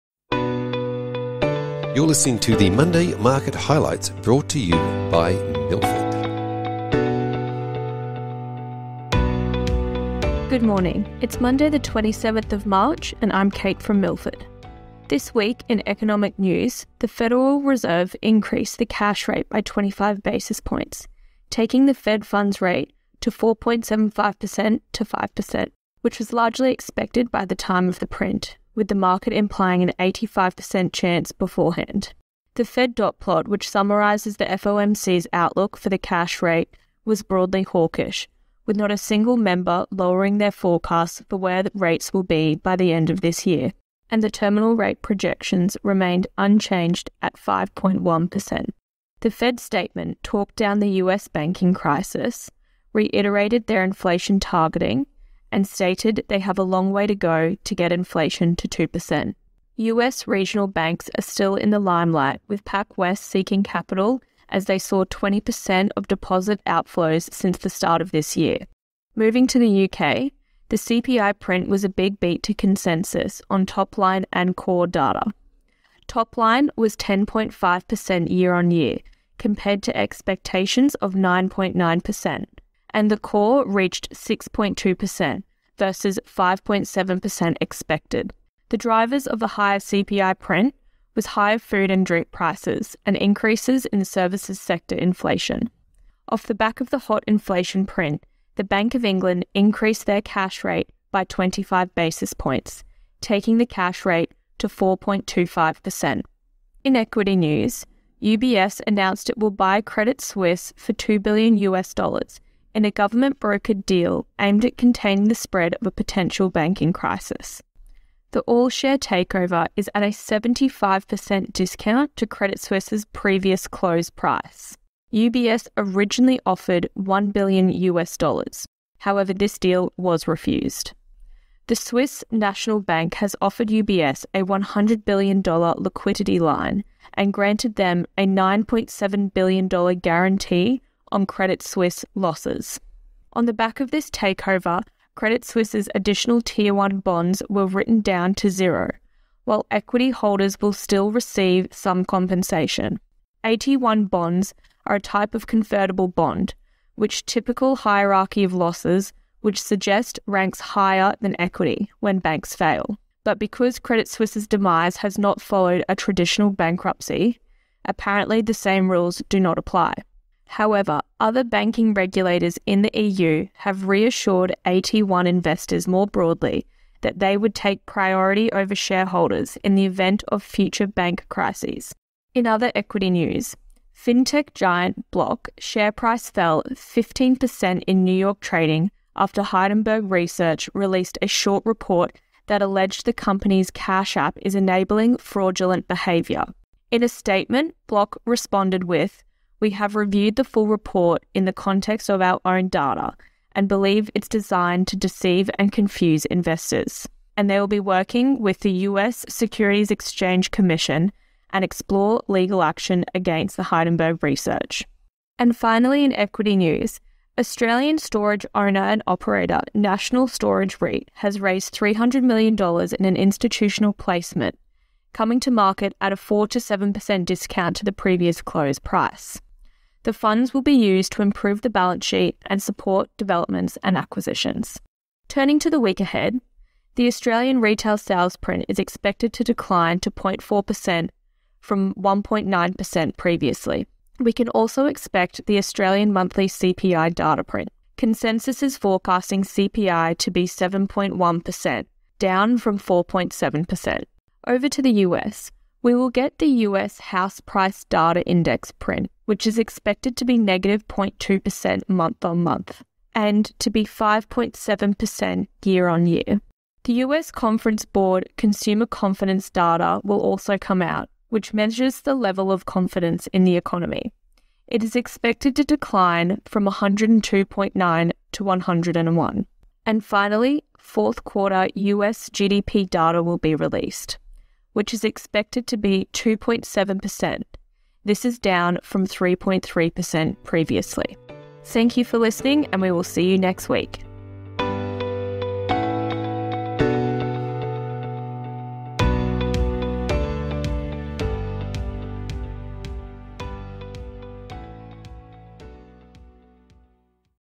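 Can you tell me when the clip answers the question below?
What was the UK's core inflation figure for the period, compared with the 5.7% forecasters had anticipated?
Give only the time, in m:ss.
1:24.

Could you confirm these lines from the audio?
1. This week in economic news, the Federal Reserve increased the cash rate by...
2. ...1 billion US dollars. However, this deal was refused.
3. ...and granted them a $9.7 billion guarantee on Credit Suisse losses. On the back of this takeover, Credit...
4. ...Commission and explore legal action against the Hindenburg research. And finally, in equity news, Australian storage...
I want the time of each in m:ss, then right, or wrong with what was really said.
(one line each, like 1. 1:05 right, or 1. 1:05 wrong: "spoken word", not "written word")
1. 0:15 right
2. 2:06 right
3. 2:17 right
4. 3:30 right.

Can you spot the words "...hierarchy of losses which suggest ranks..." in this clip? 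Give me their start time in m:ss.
2:37.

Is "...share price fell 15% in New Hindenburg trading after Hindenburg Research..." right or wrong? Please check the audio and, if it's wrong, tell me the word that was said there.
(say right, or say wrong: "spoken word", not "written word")
wrong: "York", not "Hindenburg".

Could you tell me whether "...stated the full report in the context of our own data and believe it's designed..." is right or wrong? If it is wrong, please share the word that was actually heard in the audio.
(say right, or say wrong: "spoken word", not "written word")
wrong: "reviewed", not "stated".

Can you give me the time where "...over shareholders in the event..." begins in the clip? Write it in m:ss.
2:58.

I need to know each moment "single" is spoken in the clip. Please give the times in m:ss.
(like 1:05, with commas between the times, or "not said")
0:38.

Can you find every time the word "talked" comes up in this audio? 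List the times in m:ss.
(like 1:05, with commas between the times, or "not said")
0:50.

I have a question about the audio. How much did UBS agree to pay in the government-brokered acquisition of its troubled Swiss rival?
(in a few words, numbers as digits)
2 billion US dollars.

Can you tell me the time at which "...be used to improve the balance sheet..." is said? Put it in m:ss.
3:50.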